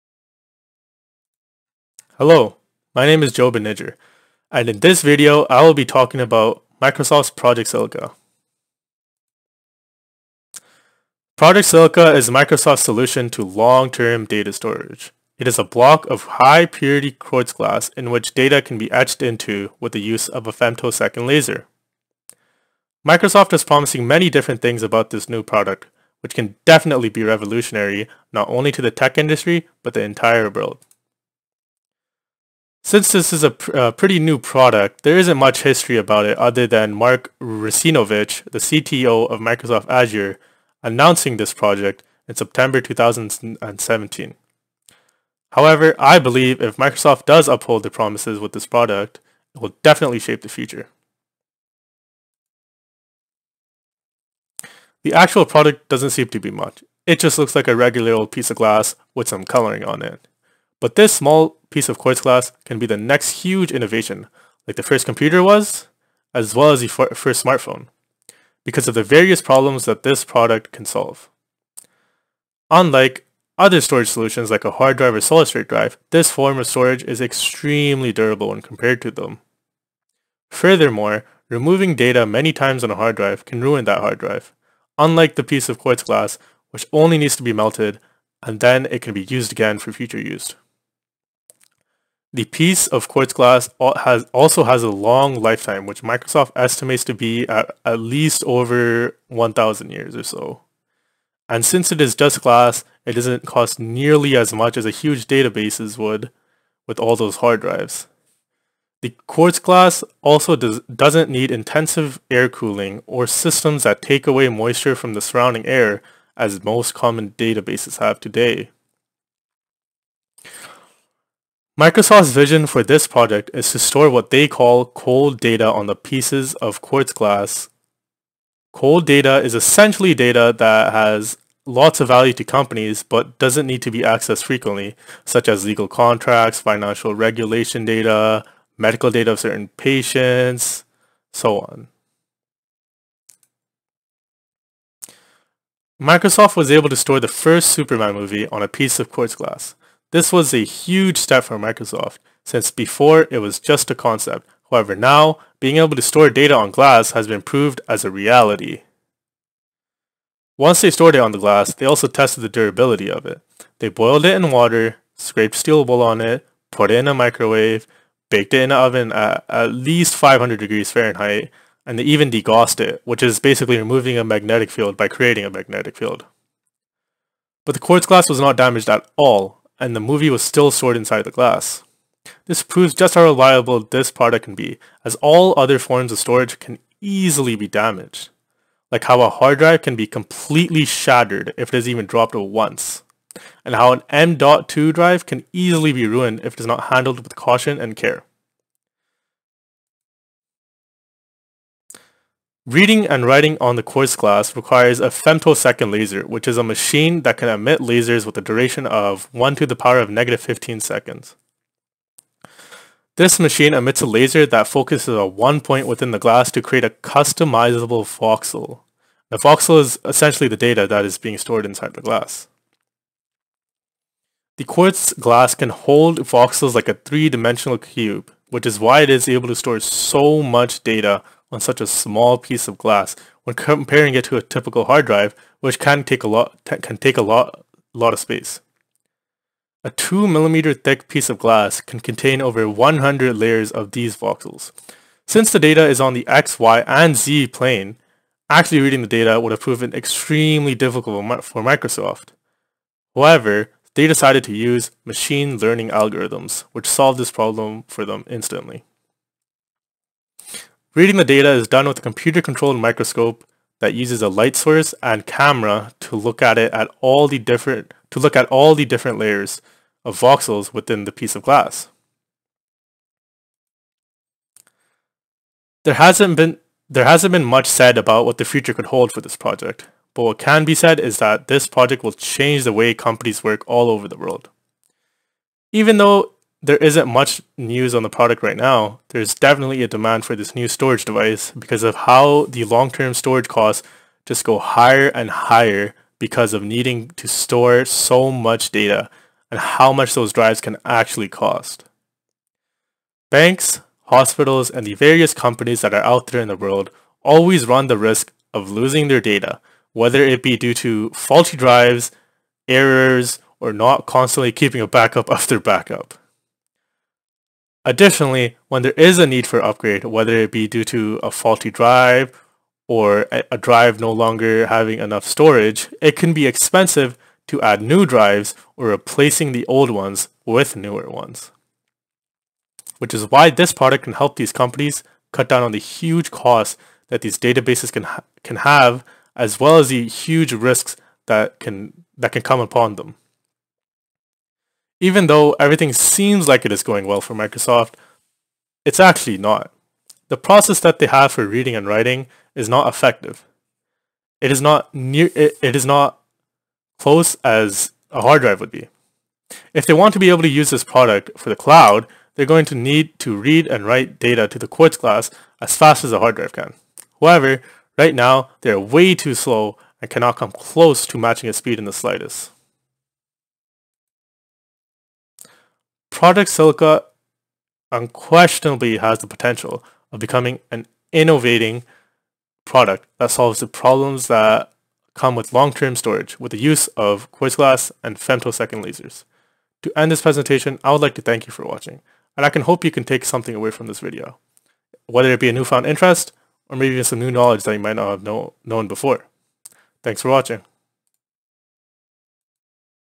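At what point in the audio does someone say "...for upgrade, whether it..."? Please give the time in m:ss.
5:19.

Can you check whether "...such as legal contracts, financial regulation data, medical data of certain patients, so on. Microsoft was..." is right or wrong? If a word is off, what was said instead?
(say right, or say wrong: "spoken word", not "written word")
right.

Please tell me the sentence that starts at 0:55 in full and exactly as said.
The actual product doesn't seem to be much.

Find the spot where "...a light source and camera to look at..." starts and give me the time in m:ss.
4:24.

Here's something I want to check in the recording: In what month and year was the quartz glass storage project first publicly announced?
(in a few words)
September 2017.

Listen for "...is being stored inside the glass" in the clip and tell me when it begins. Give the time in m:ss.
3:41.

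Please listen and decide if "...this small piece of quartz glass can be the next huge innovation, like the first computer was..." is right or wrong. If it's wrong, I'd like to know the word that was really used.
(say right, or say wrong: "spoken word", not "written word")
right.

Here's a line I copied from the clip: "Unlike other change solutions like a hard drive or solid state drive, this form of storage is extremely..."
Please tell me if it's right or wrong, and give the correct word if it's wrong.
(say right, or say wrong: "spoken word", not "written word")
wrong: "storage", not "change".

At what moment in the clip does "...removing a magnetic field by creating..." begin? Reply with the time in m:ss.
2:53.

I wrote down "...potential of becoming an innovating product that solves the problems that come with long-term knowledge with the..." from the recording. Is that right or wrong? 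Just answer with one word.
wrong.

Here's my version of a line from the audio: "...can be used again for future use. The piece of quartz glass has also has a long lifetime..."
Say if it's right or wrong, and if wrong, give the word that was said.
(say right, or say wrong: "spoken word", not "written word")
right.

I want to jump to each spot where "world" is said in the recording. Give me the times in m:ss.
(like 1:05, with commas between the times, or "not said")
0:30, 4:44, 5:06.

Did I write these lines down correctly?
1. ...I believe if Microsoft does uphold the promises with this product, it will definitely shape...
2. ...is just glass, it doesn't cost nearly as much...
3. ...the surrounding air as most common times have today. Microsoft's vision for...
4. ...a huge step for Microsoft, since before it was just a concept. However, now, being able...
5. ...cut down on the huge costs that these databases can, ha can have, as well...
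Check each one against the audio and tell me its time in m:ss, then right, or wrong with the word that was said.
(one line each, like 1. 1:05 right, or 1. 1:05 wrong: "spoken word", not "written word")
1. 0:45 right
2. 1:41 right
3. 1:55 wrong: "databases", not "times"
4. 2:30 right
5. 5:35 right.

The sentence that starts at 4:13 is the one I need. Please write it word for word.
However, they decided to use machine learning algorithms, which solved this problem for them instantly.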